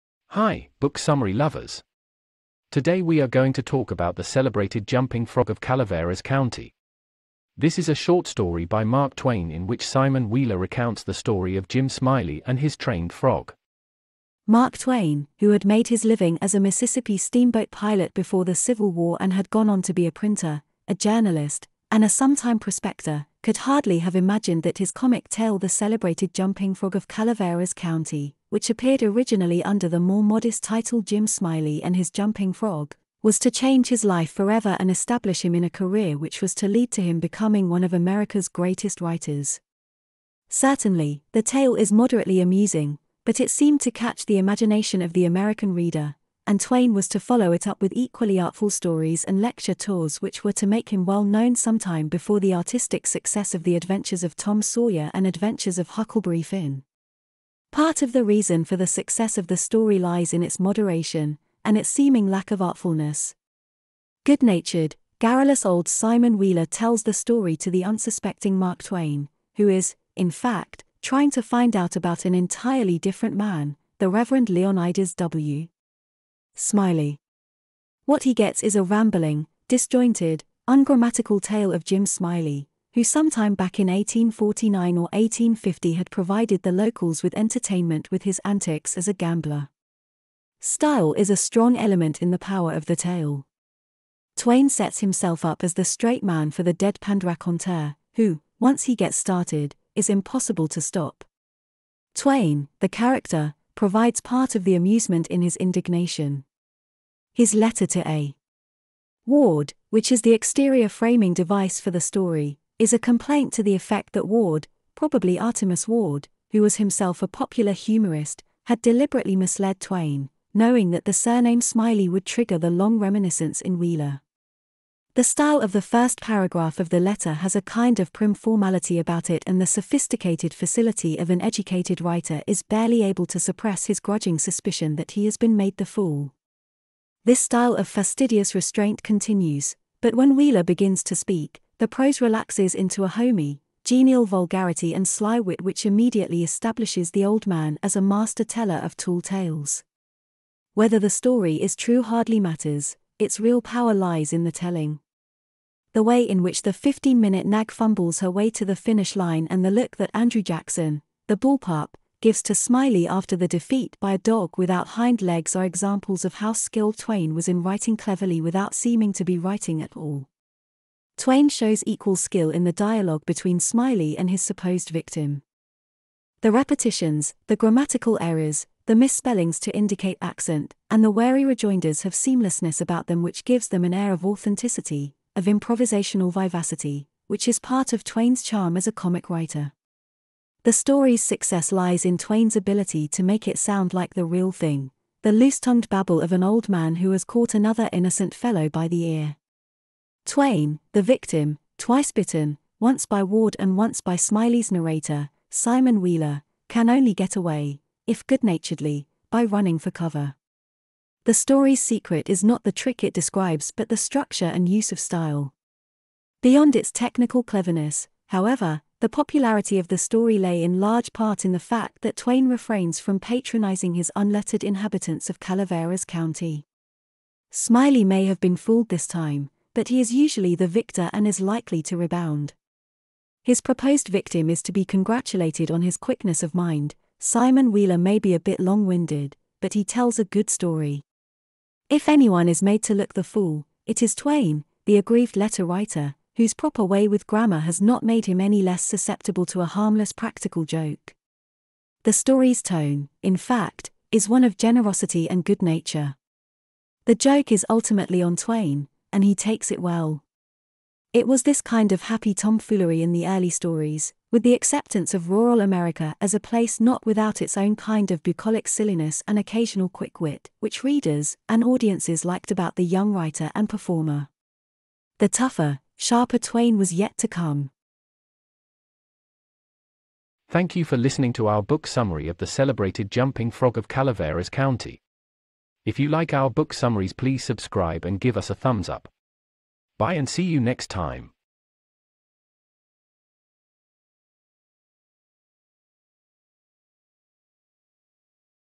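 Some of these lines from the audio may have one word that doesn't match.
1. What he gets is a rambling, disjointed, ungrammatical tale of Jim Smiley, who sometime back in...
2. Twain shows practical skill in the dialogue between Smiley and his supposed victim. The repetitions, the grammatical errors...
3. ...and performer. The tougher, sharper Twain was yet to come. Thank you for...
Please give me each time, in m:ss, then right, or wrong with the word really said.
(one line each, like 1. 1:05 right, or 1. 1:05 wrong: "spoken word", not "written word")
1. 1:18 right
2. 2:51 wrong: "equal", not "practical"
3. 4:33 right.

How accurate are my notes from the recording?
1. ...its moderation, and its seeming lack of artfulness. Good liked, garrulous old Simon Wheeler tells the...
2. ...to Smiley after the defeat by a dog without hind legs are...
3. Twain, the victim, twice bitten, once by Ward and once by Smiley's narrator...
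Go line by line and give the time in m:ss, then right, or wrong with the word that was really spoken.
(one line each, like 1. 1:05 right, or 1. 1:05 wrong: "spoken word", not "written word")
1. 1:00 wrong: "natured", not "liked"
2. 2:42 right
3. 3:20 right.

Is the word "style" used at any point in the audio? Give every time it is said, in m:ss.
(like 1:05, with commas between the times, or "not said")
1:30, 2:05, 2:17, 3:34.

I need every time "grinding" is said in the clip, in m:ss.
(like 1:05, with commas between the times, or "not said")
not said.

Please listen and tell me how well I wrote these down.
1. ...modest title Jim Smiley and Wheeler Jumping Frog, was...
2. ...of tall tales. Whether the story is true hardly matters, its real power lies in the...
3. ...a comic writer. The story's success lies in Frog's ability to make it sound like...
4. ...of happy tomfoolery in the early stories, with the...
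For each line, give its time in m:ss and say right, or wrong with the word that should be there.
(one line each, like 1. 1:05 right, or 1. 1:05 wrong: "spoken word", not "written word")
1. 0:30 wrong: "His", not "Wheeler"
2. 2:28 right
3. 3:08 wrong: "Twain", not "Frog"
4. 4:21 right.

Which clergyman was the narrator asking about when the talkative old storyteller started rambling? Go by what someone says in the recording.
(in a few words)
Reverend Leonidas W. Smiley.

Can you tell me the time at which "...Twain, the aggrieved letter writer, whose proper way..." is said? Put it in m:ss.
4:04.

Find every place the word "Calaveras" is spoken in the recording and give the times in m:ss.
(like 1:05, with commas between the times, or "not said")
0:05, 0:27, 3:45, 4:43.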